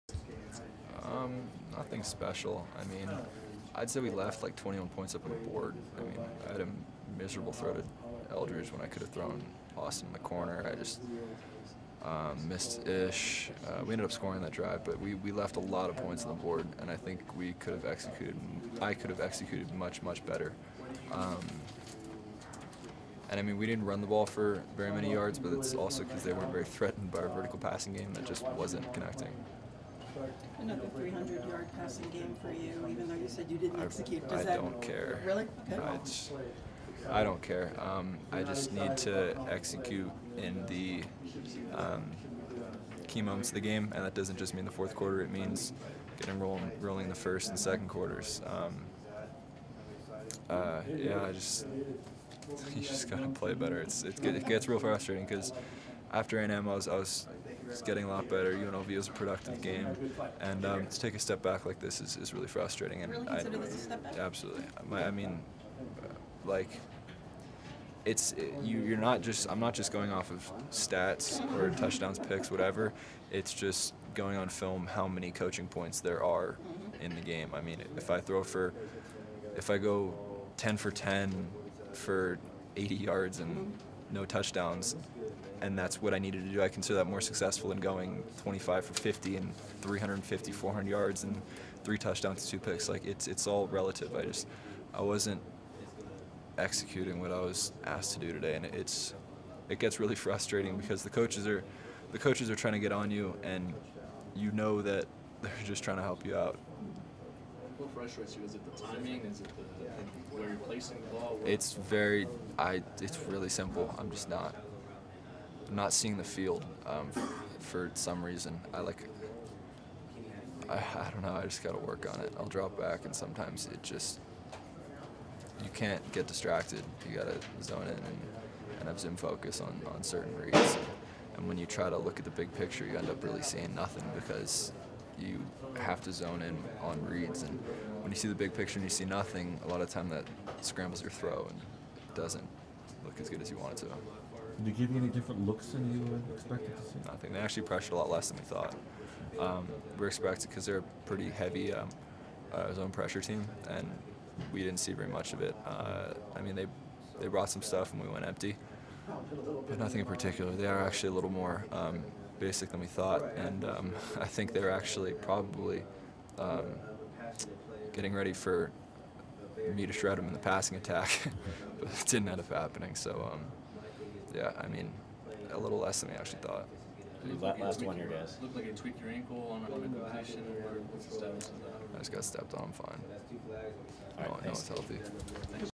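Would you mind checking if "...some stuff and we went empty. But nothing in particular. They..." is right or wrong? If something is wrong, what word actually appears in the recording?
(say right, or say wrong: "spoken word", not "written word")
right.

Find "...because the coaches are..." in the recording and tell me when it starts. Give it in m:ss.
1:40.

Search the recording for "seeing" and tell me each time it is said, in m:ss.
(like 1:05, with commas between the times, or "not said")
1:55, 2:13.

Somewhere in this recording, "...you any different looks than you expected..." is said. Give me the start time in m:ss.
2:24.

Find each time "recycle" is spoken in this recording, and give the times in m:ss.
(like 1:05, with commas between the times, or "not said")
not said.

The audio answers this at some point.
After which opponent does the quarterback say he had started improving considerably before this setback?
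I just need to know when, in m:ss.
0:56.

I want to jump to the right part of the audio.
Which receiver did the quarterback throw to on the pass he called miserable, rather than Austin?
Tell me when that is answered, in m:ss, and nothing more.
0:08.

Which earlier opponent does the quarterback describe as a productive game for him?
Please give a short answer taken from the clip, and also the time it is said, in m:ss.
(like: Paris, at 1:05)
UNLV, at 0:58.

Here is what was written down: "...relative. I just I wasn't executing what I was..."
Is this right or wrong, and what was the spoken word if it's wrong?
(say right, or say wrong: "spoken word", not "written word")
right.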